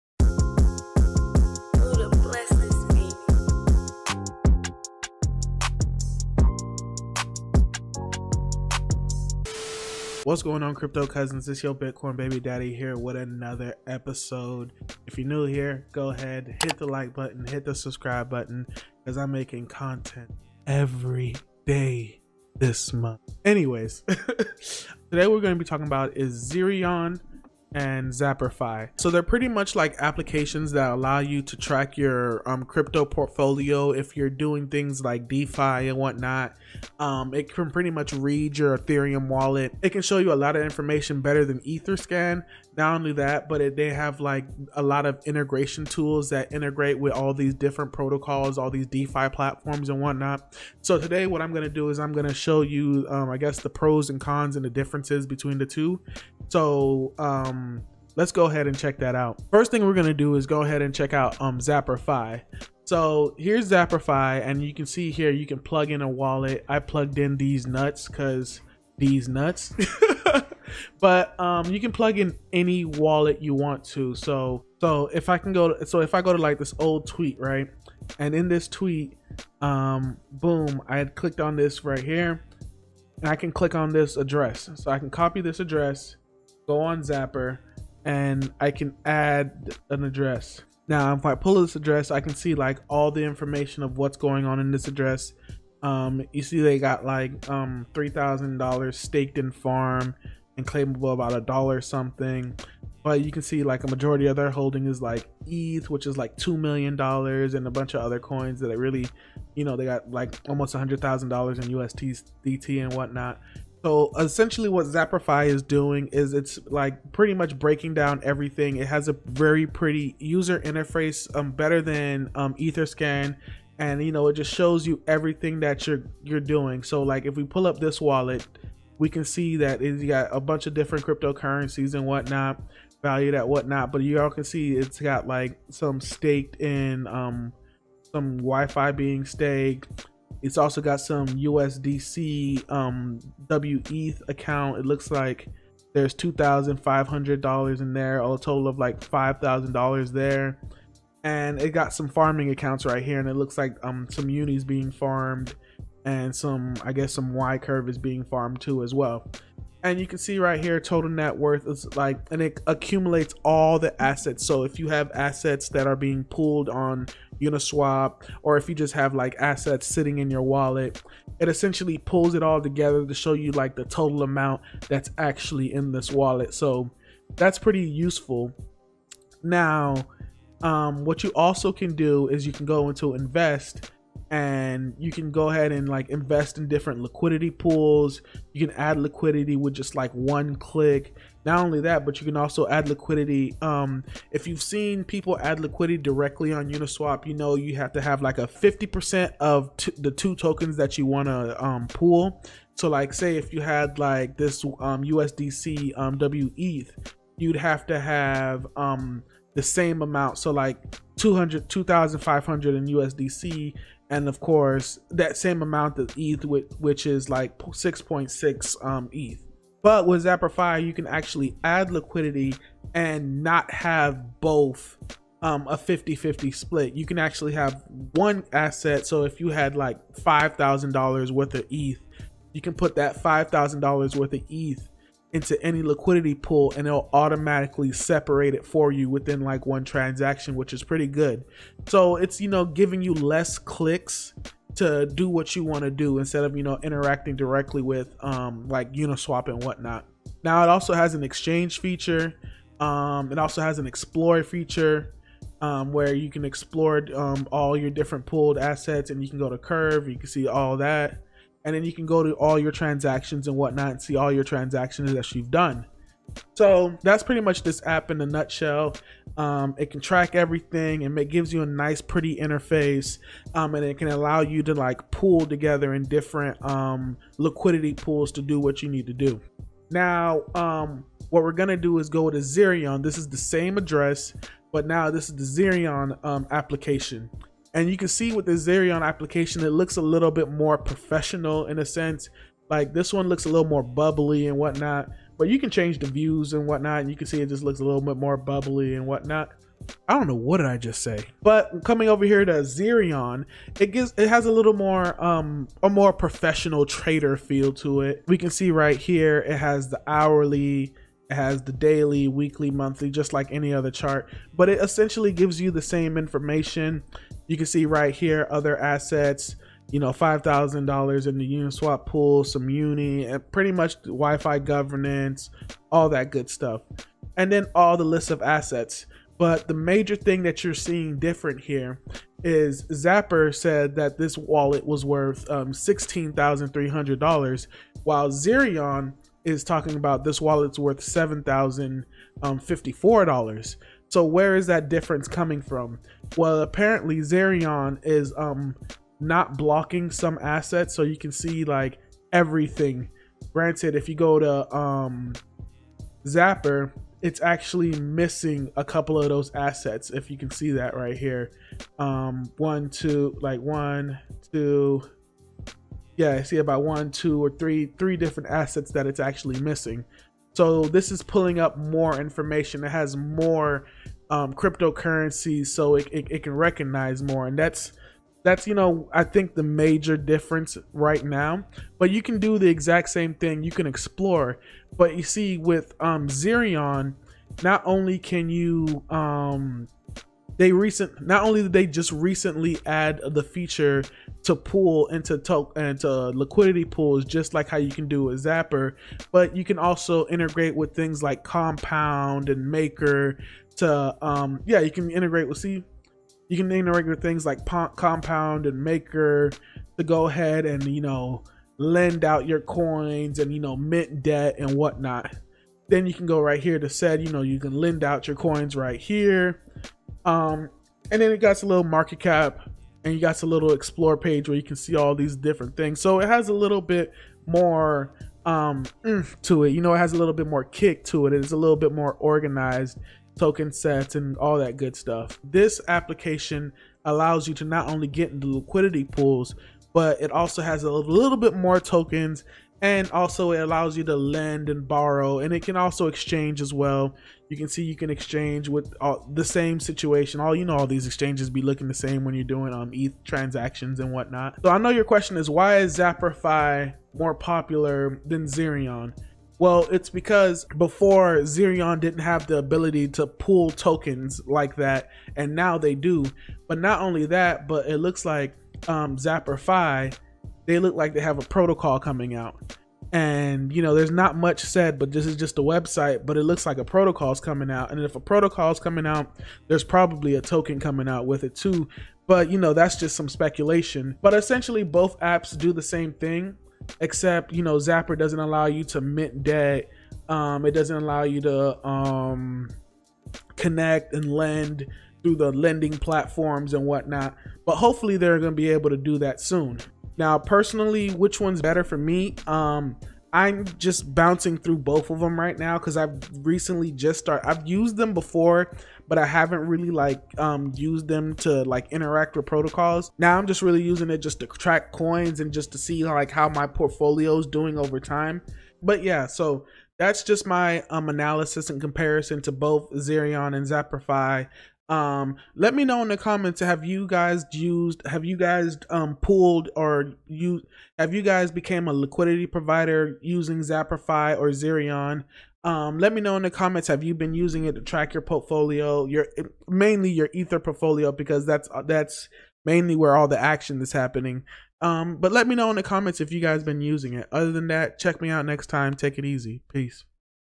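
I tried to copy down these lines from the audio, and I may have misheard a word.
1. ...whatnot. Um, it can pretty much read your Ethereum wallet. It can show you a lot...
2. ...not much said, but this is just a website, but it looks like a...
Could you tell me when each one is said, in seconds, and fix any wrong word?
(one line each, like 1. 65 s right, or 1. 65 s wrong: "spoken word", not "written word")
1. 35 s right
2. 474 s right.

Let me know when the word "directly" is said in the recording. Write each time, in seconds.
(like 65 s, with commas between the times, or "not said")
195 s, 247 s.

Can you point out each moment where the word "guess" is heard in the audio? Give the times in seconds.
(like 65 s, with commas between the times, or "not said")
53 s, 156 s.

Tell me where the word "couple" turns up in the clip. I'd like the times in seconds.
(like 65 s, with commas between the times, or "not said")
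358 s.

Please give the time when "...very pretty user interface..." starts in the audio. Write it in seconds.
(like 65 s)
119 s.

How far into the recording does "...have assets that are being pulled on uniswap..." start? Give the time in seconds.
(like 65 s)
164 s.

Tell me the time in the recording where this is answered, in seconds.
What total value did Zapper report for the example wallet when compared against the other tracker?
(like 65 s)
335 s.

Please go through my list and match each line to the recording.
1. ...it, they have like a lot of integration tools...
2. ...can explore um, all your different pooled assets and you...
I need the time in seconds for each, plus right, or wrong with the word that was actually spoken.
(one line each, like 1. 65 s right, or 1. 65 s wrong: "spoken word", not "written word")
1. 43 s right
2. 256 s right.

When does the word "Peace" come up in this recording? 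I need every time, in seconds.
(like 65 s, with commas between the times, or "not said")
549 s.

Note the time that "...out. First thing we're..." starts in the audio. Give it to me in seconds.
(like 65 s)
59 s.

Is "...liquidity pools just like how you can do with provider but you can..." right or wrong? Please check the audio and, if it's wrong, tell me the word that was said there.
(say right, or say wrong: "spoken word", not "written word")
wrong: "zapper", not "provider".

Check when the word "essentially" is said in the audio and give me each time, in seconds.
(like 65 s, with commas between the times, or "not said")
114 s, 171 s, 314 s, 484 s.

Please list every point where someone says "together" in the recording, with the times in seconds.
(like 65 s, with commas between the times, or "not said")
172 s, 275 s.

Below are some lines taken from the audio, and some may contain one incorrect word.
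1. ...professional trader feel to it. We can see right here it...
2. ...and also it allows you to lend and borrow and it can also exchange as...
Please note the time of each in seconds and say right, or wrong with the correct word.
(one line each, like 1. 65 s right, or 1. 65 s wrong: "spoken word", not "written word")
1. 306 s right
2. 442 s right.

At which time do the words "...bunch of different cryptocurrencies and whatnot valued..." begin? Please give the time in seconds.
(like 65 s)
130 s.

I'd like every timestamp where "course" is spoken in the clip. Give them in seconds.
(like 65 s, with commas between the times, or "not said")
214 s.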